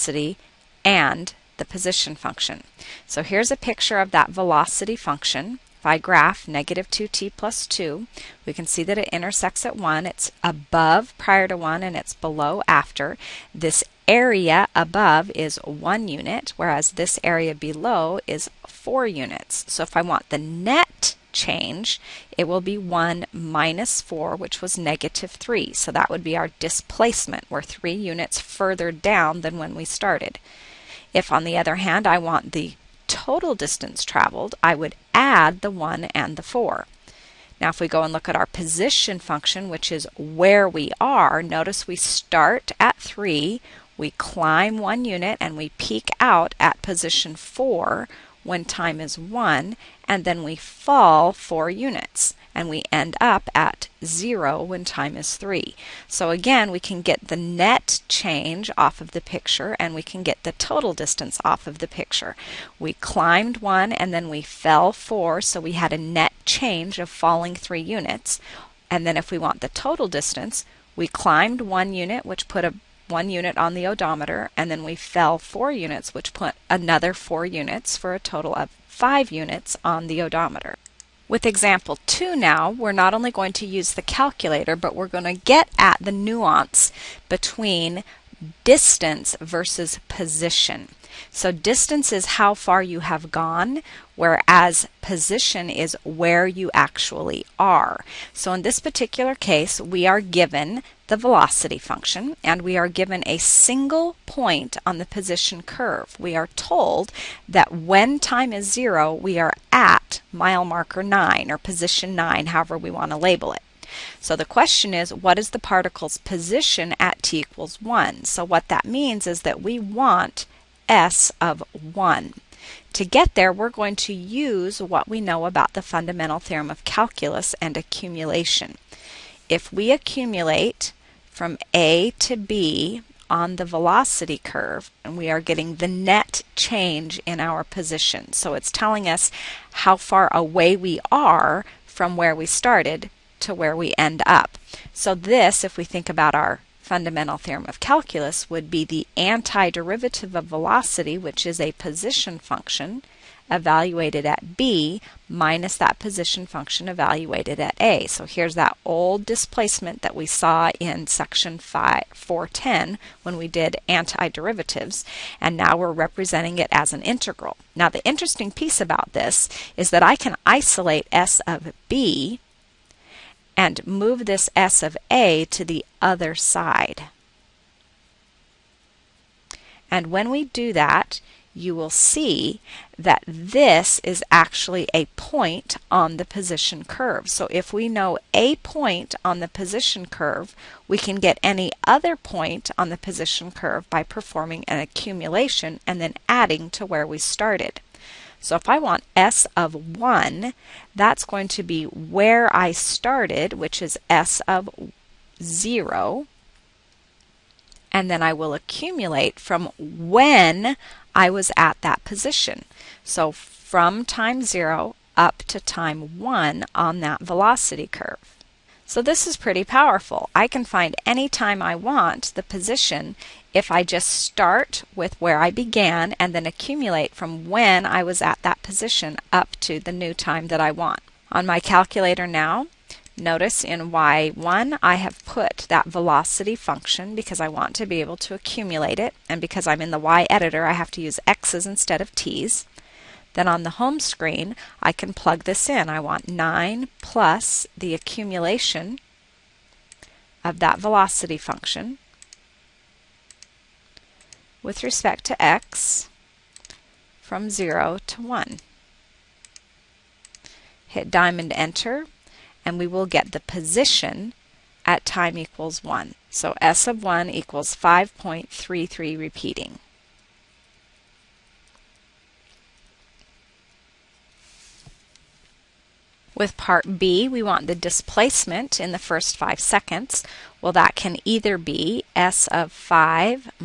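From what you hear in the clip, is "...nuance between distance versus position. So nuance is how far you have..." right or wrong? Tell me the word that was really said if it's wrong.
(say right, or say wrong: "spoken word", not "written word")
wrong: "distance", not "nuance".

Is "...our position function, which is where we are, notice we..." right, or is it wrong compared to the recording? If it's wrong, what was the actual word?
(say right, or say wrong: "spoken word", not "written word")
right.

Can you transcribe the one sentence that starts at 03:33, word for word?
So from time 0 up to time 1 on that velocity curve.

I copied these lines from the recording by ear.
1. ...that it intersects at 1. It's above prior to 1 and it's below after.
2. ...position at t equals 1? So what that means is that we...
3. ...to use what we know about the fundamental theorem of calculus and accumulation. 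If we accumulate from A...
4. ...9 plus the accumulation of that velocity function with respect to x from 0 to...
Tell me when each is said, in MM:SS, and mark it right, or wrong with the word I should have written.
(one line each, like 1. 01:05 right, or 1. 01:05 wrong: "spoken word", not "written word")
1. 00:08 right
2. 01:56 right
3. 02:03 right
4. 04:06 right.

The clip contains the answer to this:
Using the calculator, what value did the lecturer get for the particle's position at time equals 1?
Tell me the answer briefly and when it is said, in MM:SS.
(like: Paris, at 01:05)
5.33 repeating, at 04:27.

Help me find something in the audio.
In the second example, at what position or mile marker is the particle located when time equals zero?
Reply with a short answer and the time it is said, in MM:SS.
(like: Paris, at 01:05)
9, at 01:50.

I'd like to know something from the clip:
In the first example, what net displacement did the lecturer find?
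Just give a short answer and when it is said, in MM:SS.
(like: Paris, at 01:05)
-3, at 00:24.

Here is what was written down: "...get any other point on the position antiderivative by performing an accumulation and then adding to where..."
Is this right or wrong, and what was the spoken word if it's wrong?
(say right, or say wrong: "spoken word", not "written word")
wrong: "curve", not "antiderivative".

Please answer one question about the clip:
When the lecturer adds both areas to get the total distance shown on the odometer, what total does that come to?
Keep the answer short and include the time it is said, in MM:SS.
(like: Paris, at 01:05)
5 units, at 01:18.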